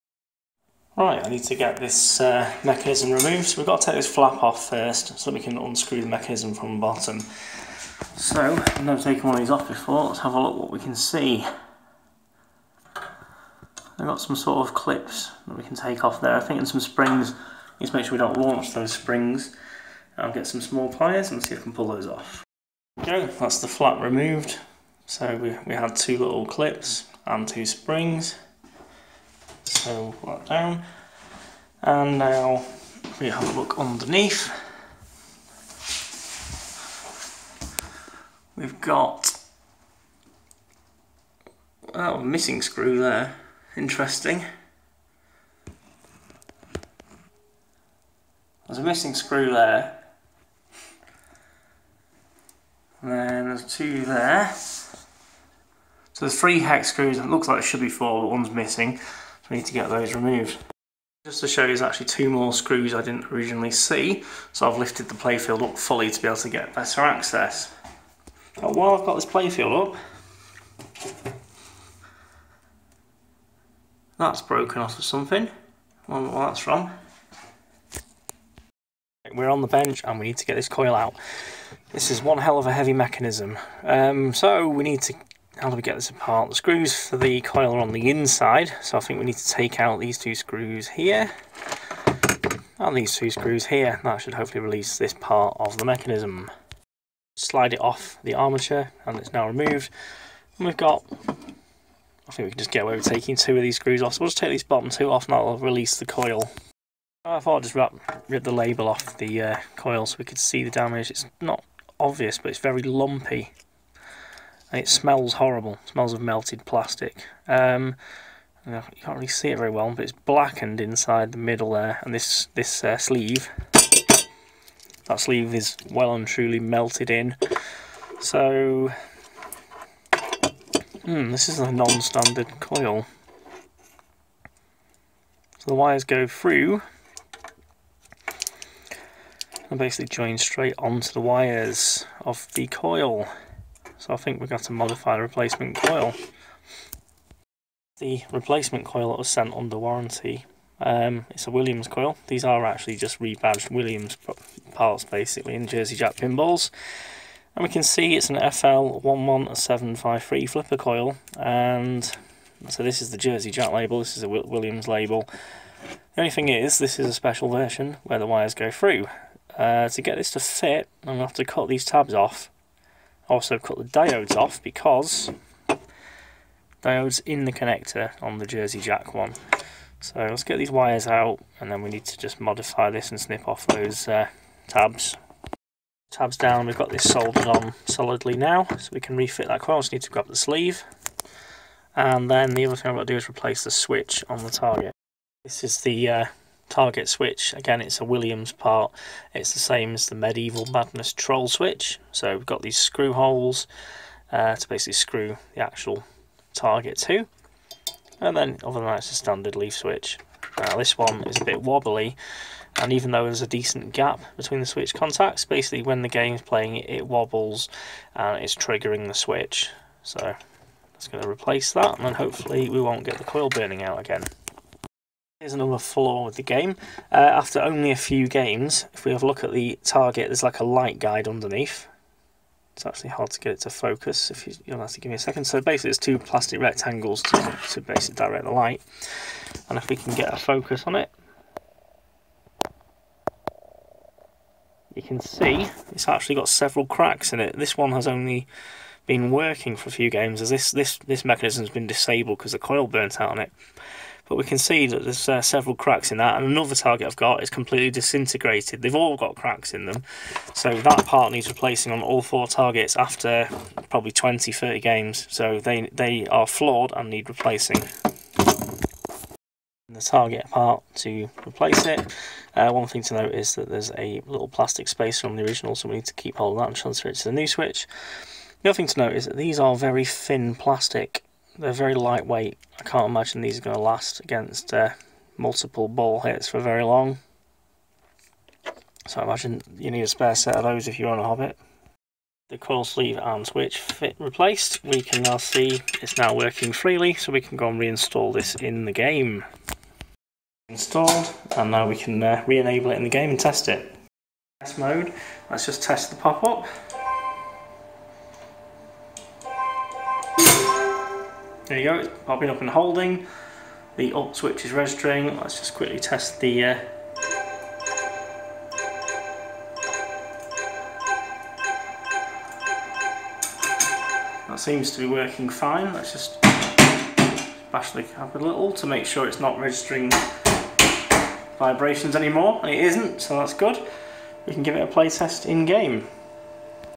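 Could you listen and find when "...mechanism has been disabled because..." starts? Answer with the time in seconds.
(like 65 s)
251 s.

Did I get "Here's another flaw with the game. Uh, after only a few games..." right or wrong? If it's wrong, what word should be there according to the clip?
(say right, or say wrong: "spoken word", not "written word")
right.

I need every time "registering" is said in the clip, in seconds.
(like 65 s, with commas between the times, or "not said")
314 s, 329 s.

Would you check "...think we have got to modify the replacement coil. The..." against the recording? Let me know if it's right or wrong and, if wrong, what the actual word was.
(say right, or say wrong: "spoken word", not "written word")
right.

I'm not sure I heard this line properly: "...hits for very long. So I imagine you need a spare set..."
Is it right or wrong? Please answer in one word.
right.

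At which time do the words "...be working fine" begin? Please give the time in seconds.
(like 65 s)
324 s.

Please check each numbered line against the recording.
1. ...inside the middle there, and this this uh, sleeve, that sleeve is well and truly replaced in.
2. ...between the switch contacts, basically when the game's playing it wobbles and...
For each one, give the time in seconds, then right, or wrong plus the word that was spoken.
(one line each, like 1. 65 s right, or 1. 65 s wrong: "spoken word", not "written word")
1. 120 s wrong: "melted", not "replaced"
2. 214 s right.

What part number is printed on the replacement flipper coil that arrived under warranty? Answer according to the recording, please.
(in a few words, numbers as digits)
FL11753.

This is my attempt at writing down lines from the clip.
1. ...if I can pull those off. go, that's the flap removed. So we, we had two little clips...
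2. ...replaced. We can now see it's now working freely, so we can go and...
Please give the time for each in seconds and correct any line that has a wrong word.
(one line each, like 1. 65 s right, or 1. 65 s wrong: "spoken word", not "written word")
1. 21 s right
2. 294 s right.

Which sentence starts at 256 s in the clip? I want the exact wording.
And another target I've got is completely disintegrated.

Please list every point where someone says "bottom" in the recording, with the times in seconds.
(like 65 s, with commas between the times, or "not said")
6 s, 104 s.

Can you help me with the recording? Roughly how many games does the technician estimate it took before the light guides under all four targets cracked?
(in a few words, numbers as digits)
20-30.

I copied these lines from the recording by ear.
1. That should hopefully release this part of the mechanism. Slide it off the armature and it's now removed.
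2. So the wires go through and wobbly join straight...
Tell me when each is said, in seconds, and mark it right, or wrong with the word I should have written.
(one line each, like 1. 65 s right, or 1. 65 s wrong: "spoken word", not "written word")
1. 94 s right
2. 135 s wrong: "basically", not "wobbly".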